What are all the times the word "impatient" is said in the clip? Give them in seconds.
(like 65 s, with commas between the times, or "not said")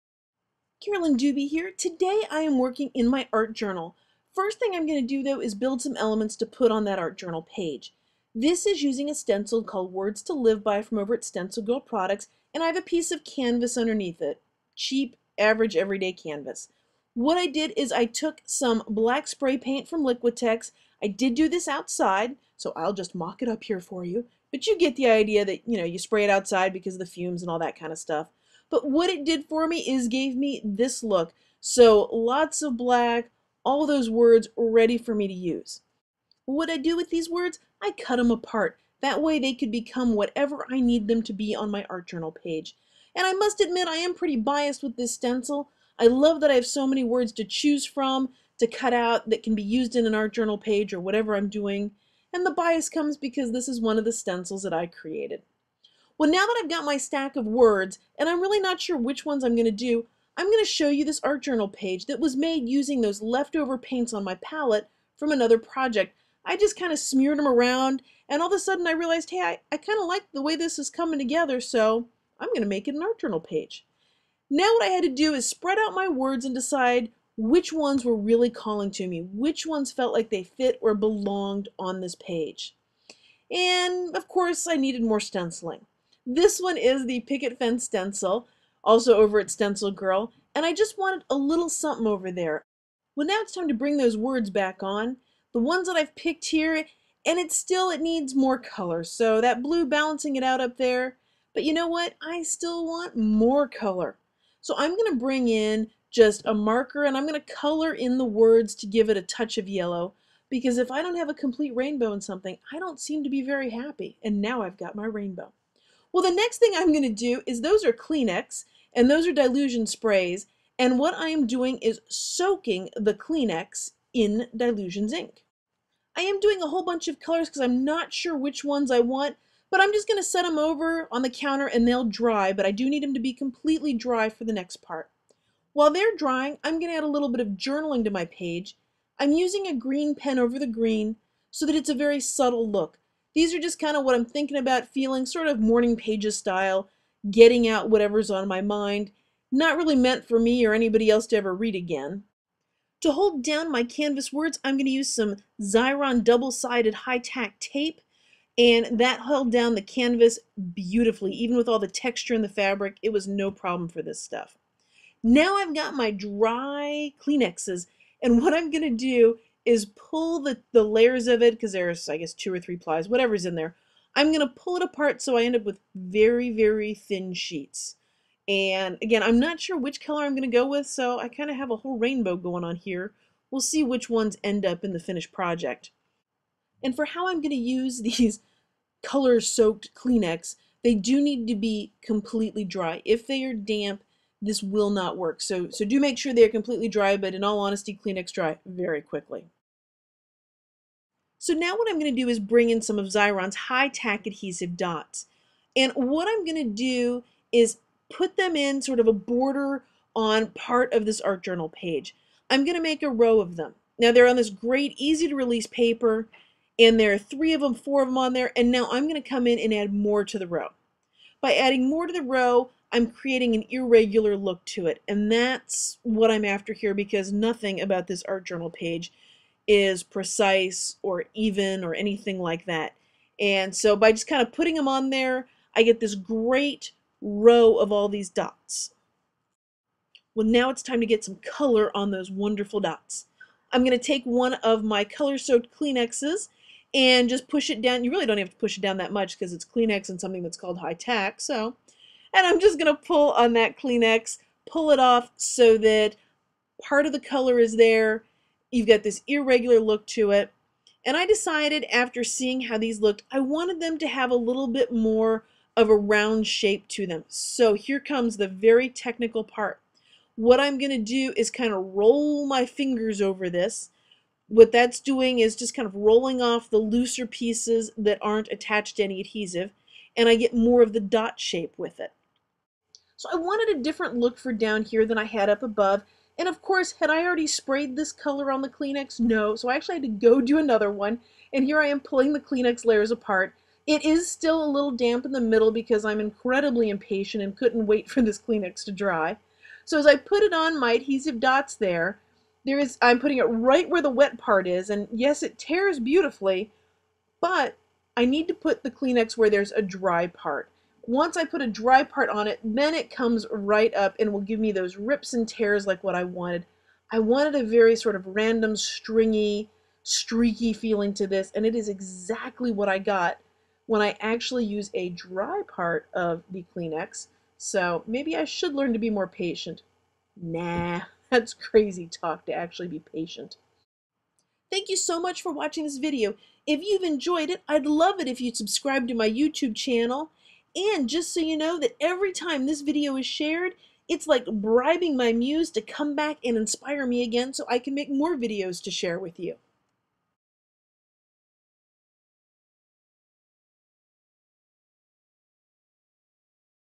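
296 s.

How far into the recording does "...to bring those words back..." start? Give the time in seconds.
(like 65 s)
93 s.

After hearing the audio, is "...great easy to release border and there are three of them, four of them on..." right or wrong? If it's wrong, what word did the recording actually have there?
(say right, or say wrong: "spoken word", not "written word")
wrong: "paper", not "border".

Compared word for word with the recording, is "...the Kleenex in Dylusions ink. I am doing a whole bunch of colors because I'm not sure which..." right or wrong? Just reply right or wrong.
right.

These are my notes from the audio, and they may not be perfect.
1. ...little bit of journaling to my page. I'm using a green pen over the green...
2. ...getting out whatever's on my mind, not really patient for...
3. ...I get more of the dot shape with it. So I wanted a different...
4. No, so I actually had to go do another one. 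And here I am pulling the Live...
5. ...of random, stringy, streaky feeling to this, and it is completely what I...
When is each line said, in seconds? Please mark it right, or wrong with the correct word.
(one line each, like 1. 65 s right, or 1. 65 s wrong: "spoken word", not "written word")
1. 137 s right
2. 147 s wrong: "meant", not "patient"
3. 280 s right
4. 289 s wrong: "Kleenex", not "Live"
5. 318 s wrong: "exactly", not "completely".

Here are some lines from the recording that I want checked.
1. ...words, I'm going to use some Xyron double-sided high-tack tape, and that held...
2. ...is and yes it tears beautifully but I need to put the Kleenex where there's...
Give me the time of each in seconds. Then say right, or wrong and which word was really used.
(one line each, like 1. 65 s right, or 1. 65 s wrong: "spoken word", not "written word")
1. 154 s right
2. 304 s right.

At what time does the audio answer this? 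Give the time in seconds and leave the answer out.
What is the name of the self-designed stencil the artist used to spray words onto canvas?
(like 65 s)
9 s.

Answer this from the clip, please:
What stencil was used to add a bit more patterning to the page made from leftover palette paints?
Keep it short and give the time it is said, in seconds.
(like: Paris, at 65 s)
Picket Fence, at 87 s.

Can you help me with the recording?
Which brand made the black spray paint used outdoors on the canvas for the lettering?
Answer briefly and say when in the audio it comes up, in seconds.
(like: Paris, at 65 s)
Liquitex, at 20 s.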